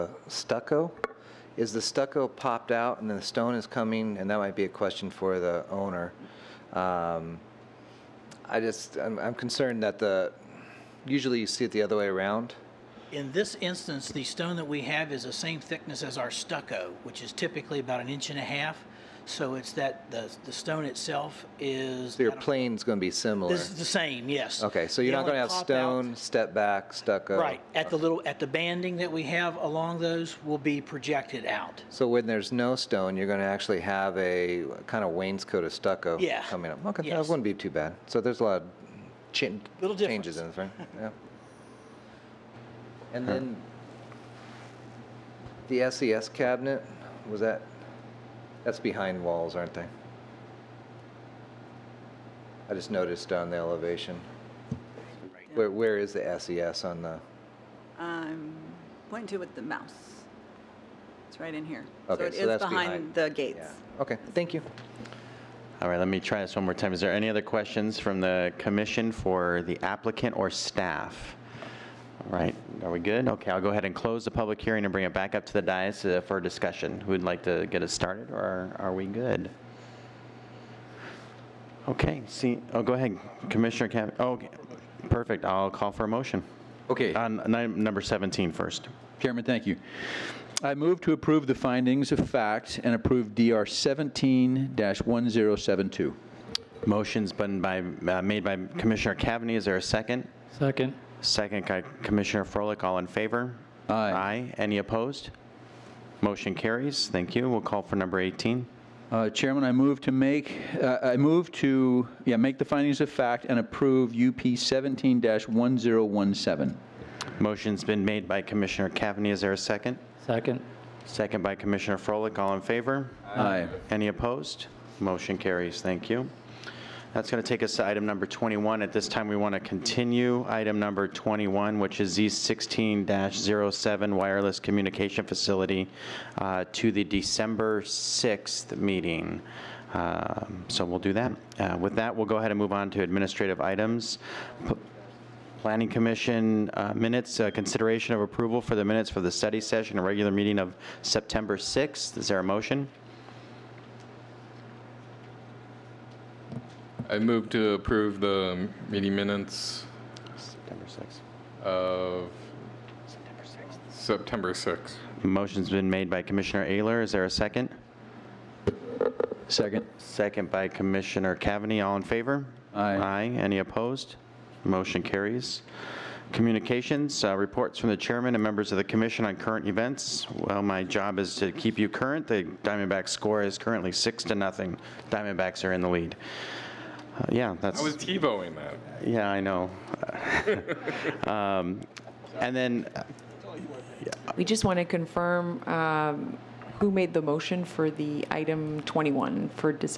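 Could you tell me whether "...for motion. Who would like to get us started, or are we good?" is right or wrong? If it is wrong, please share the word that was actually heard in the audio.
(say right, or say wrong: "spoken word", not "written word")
wrong: "discussion", not "motion".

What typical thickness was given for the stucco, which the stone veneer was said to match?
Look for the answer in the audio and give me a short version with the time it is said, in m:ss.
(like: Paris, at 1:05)
1.5 inches, at 0:18.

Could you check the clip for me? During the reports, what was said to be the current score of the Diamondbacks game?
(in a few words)
6 to 0.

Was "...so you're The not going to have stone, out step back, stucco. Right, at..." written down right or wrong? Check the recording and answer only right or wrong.
right.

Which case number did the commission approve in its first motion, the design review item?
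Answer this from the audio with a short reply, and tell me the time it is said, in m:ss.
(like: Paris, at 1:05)
DR 17-1072, at 1:33.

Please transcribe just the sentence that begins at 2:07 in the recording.
That's going to take us to item number 21.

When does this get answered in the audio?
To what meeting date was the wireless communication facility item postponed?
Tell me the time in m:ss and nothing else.
2:17.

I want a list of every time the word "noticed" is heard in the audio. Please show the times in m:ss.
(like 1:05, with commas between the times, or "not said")
0:52.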